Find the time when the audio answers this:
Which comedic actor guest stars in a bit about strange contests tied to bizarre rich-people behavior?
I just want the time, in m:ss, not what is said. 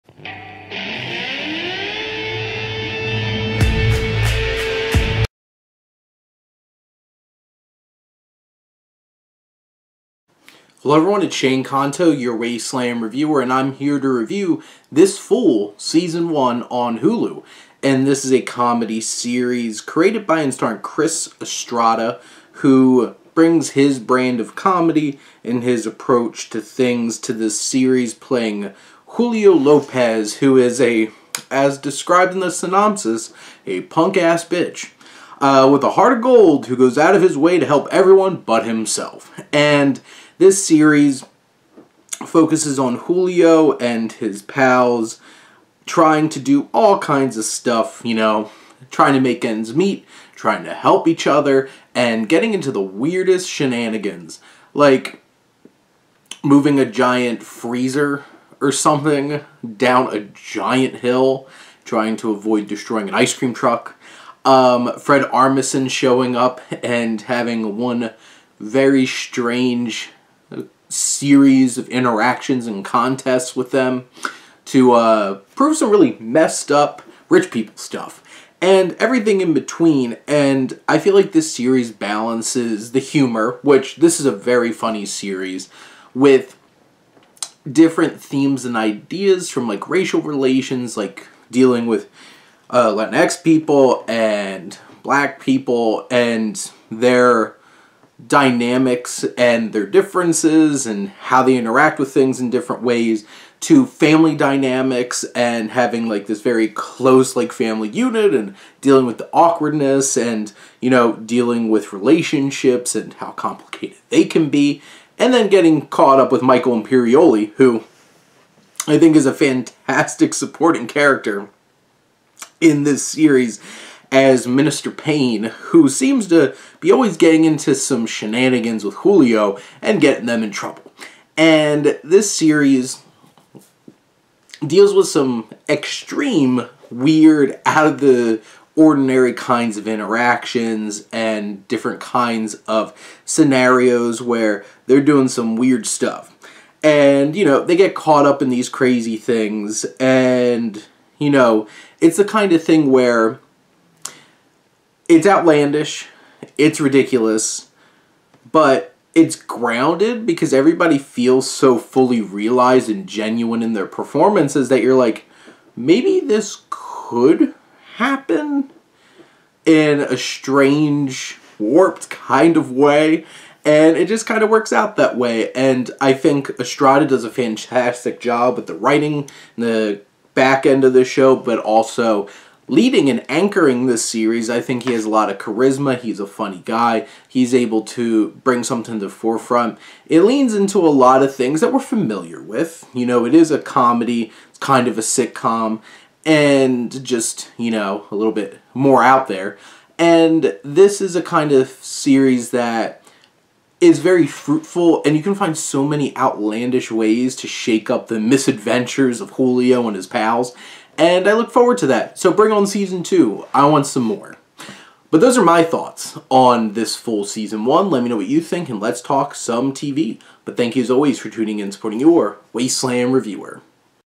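1:04.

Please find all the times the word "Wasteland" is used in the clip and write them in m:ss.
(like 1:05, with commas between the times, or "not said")
0:12, 3:42.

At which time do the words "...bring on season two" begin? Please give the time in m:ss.
3:32.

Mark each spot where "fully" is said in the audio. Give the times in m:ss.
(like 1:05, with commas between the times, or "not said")
2:41.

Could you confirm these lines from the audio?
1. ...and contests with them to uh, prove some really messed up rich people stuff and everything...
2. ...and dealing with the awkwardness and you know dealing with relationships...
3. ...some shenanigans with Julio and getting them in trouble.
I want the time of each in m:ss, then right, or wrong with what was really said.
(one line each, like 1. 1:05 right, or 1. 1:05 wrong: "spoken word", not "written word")
1. 1:12 right
2. 1:48 right
3. 2:07 right.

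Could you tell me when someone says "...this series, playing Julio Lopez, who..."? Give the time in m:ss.
0:27.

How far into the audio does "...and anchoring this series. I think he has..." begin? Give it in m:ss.
3:03.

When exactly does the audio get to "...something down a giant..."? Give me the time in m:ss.
0:58.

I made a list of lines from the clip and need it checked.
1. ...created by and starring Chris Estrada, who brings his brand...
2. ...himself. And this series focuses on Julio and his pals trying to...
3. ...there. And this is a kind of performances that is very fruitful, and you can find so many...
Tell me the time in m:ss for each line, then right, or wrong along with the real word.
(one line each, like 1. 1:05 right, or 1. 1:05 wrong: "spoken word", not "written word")
1. 0:19 right
2. 0:38 right
3. 3:19 wrong: "series", not "performances".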